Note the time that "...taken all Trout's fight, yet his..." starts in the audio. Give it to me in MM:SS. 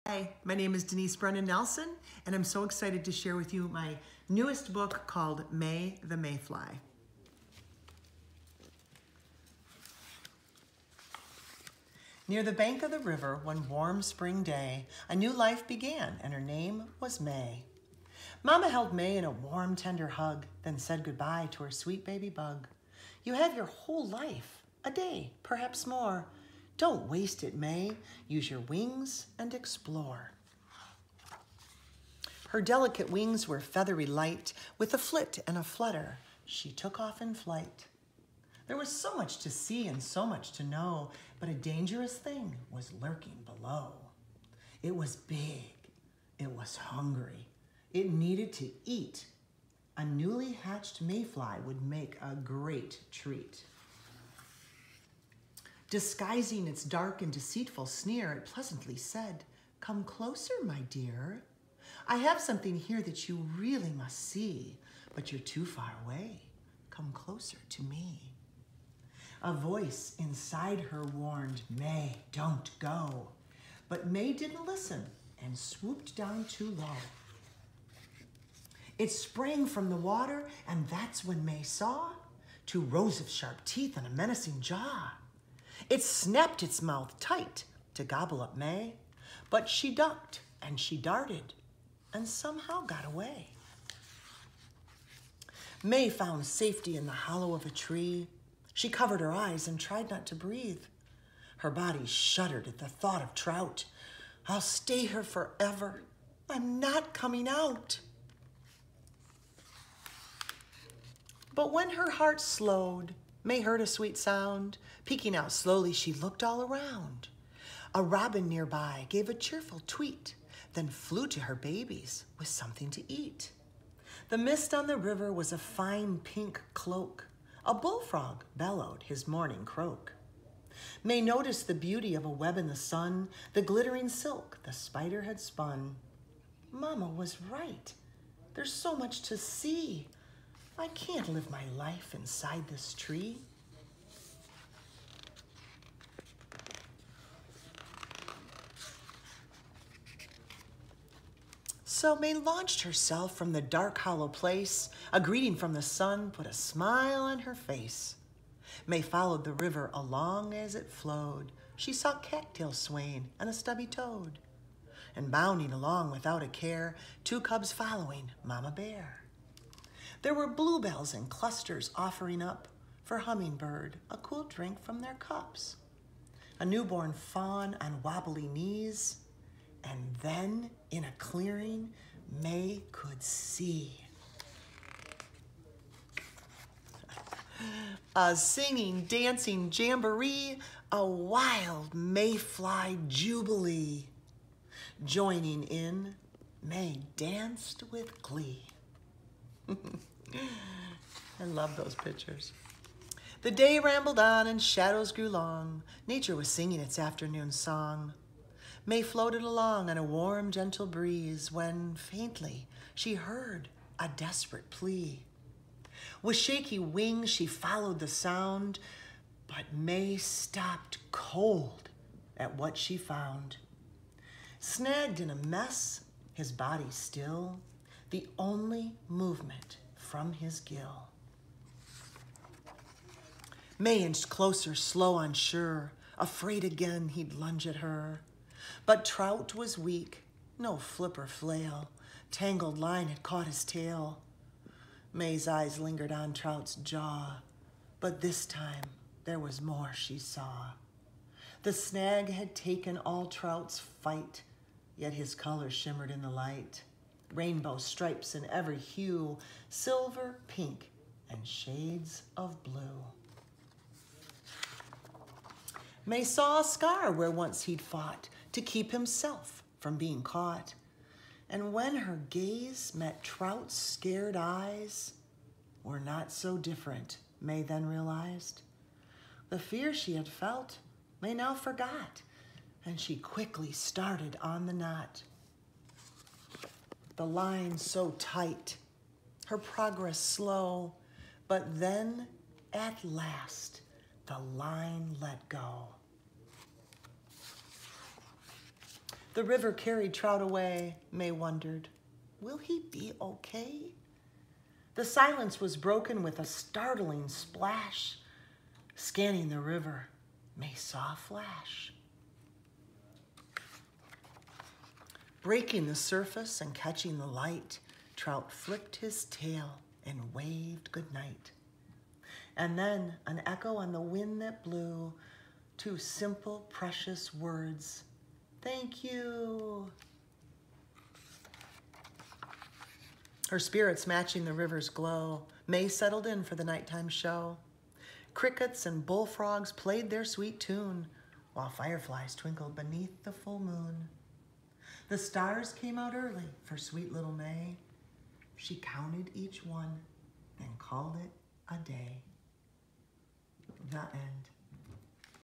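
04:12.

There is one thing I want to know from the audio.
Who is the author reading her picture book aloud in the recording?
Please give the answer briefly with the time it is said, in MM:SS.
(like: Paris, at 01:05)
Denise Brennan Nelson, at 00:00.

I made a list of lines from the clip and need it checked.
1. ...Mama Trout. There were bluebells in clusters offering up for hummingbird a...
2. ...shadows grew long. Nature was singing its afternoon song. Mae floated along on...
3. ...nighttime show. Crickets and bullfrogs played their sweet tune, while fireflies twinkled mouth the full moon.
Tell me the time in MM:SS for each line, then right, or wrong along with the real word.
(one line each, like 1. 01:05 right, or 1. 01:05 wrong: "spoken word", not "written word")
1. 02:48 wrong: "Bear", not "Trout"
2. 03:24 right
3. 05:36 wrong: "beneath", not "mouth".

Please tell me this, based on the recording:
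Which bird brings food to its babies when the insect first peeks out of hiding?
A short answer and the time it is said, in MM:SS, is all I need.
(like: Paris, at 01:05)
robin, at 01:58.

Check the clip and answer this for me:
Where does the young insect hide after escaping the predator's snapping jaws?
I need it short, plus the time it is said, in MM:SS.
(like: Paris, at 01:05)
the hollow of a tree, at 01:37.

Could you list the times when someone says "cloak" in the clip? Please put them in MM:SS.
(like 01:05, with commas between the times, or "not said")
02:06.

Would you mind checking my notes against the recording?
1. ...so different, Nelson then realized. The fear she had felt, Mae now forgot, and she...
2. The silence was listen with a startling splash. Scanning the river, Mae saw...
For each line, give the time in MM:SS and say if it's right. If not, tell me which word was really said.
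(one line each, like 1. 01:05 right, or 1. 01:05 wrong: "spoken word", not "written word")
1. 04:36 wrong: "Mae", not "Nelson"
2. 05:04 wrong: "broken", not "listen".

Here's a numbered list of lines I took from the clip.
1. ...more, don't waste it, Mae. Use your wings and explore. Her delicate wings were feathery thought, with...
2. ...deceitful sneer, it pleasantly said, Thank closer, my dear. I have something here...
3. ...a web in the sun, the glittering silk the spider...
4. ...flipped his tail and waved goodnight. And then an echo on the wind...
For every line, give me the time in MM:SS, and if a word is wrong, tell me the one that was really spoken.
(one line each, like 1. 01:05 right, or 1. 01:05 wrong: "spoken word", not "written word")
1. 00:25 wrong: "light", not "thought"
2. 00:57 wrong: "Come", not "Thank"
3. 02:12 right
4. 05:18 right.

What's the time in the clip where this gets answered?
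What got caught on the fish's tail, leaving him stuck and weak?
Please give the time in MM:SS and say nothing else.
04:02.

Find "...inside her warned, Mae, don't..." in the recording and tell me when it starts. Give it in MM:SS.
01:10.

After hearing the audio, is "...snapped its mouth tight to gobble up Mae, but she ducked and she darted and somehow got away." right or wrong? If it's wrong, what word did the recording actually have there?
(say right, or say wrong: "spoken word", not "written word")
right.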